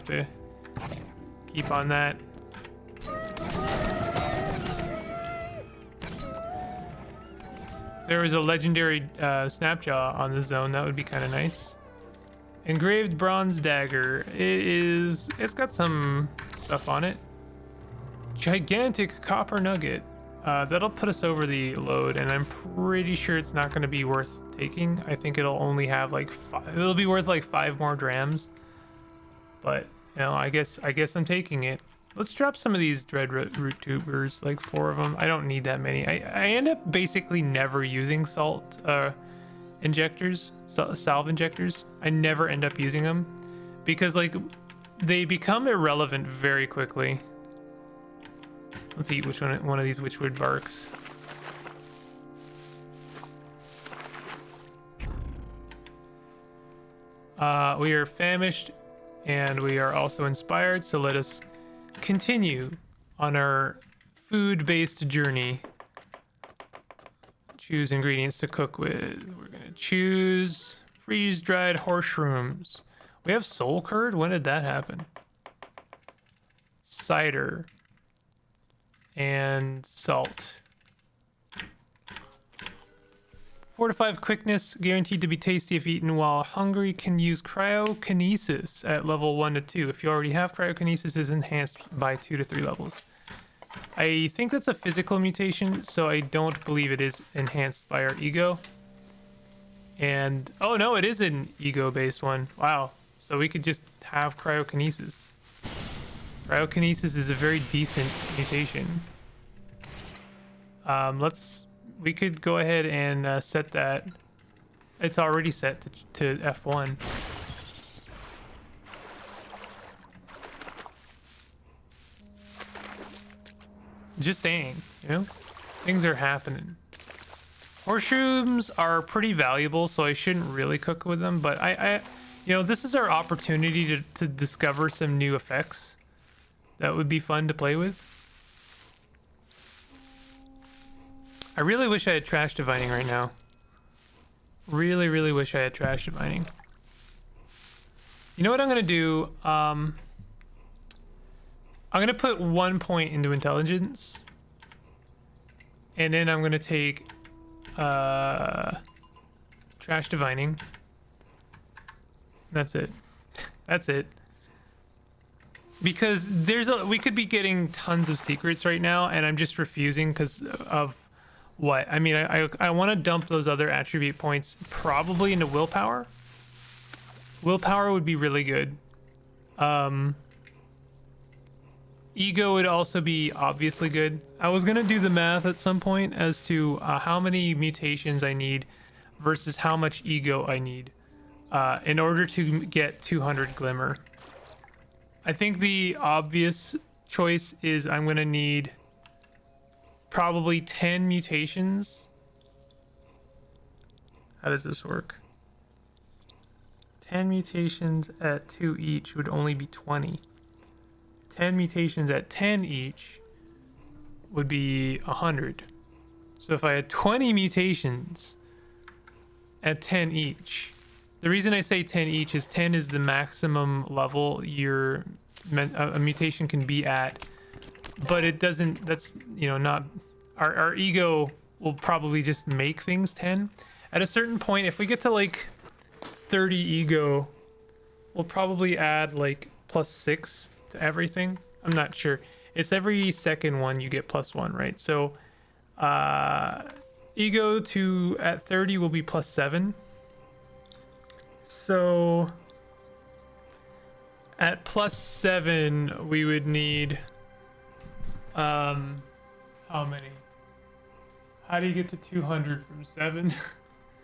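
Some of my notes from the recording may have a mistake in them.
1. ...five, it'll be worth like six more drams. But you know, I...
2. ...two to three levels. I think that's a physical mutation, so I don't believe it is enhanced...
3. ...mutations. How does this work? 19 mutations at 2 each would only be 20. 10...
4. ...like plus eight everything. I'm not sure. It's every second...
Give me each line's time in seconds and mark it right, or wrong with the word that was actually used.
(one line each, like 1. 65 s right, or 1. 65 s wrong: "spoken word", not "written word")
1. 26 s wrong: "five", not "six"
2. 92 s right
3. 201 s wrong: "10", not "19"
4. 239 s wrong: "six", not "eight".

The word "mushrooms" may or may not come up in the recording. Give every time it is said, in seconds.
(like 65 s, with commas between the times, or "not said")
71 s, 127 s.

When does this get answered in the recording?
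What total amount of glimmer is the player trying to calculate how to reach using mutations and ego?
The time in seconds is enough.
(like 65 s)
193 s.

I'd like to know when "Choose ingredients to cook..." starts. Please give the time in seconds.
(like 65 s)
67 s.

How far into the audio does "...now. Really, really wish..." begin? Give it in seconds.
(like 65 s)
143 s.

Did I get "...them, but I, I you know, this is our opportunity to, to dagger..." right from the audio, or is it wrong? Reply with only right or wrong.
wrong.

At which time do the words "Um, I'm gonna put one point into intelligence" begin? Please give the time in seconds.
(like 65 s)
149 s.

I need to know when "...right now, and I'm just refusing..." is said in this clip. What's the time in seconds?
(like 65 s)
168 s.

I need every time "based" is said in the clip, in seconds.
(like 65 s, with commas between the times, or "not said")
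64 s, 101 s.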